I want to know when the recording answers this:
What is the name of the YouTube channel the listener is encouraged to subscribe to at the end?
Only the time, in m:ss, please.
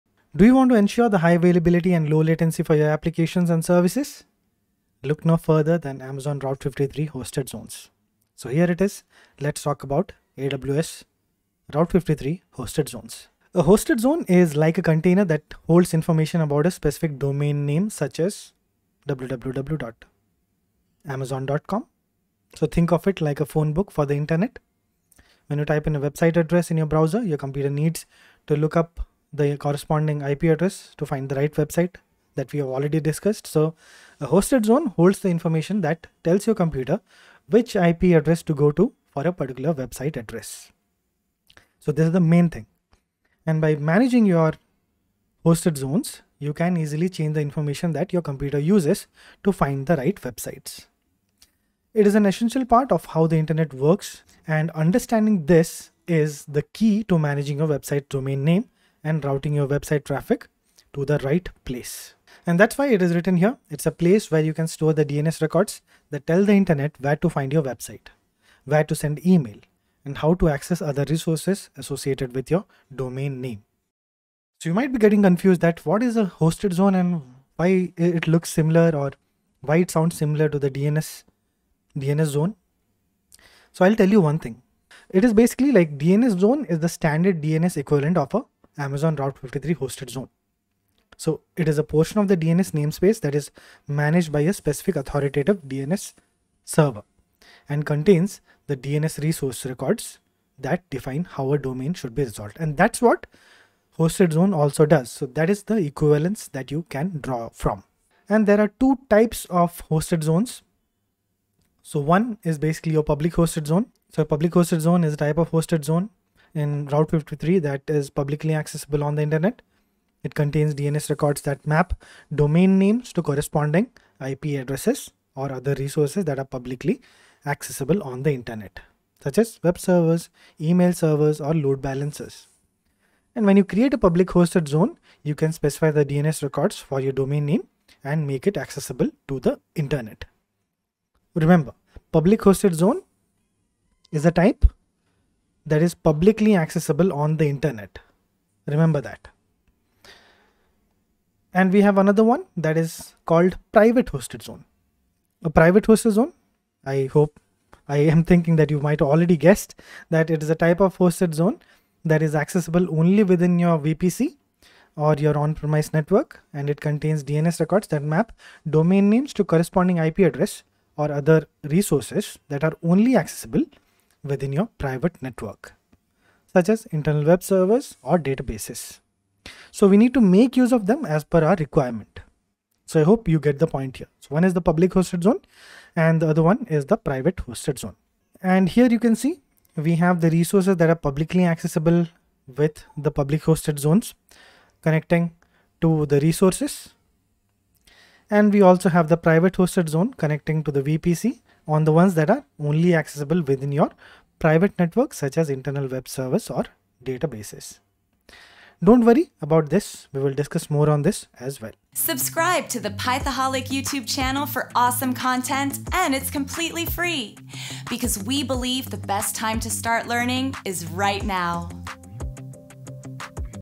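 3:32.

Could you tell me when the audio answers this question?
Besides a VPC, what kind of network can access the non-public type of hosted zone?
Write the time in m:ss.
2:45.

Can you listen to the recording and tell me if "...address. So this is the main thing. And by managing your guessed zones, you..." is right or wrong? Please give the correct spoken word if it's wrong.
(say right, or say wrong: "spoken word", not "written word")
wrong: "hosted", not "guessed".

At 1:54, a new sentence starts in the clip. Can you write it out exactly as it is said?
So a public hosted zone is a type of hosted zone in Route 53 that is publicly accessible on the internet.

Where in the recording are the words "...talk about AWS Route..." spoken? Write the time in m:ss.
0:09.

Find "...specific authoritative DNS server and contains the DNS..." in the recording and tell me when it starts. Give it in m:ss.
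1:34.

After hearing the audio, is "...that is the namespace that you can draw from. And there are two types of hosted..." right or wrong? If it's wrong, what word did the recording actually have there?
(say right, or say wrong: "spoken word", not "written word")
wrong: "equivalence", not "namespace".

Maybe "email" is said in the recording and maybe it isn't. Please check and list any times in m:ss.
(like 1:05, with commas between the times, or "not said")
1:09, 2:10.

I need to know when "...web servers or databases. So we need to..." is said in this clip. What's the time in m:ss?
2:57.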